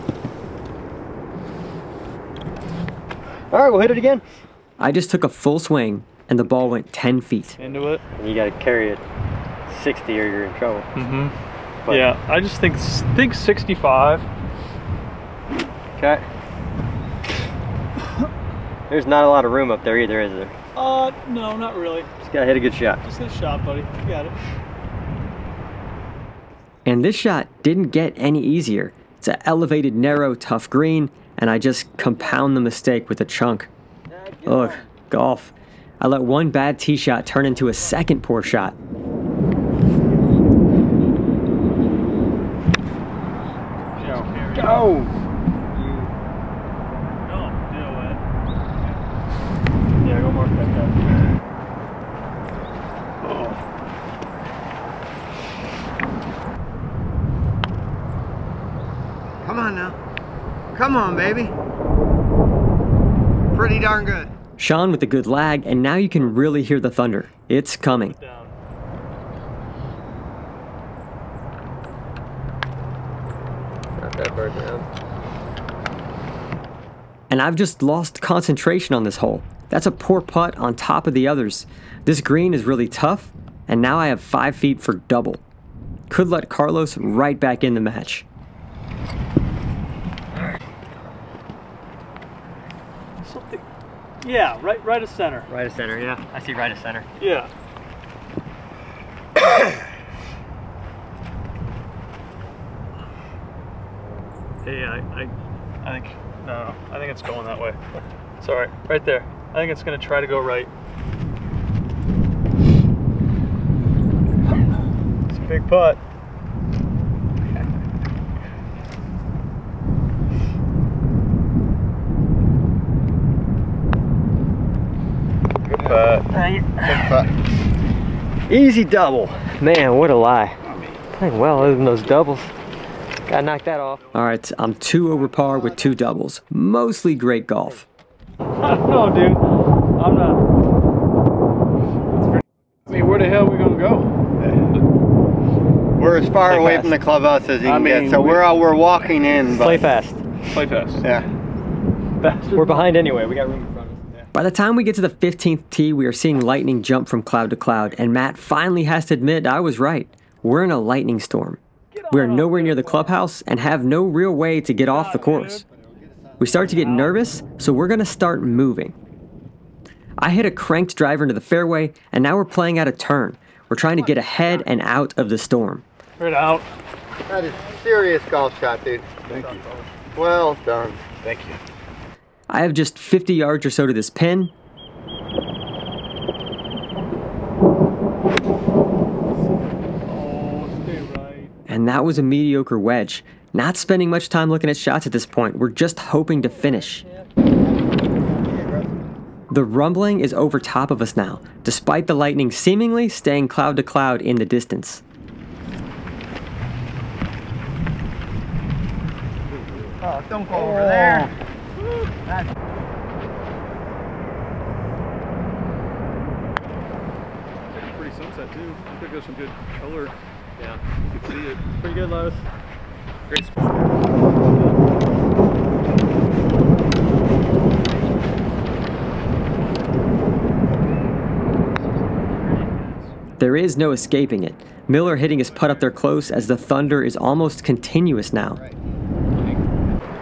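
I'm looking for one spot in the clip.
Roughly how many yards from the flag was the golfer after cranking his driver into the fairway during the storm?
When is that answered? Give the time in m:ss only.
3:02.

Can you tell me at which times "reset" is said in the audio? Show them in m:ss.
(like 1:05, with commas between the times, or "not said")
not said.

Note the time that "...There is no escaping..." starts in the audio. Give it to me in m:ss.
3:53.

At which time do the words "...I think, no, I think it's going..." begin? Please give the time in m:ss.
1:45.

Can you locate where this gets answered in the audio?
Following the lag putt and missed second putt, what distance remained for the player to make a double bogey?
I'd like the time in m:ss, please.
1:24.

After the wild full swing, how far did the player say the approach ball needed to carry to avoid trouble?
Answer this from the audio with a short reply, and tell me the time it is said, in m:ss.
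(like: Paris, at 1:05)
60, at 0:09.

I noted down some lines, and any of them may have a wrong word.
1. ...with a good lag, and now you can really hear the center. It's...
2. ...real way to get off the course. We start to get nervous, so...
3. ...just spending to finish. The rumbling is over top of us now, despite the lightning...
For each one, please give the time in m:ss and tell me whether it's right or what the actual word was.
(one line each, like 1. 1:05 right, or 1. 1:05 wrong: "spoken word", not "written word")
1. 1:04 wrong: "thunder", not "center"
2. 2:44 right
3. 3:15 wrong: "hoping", not "spending".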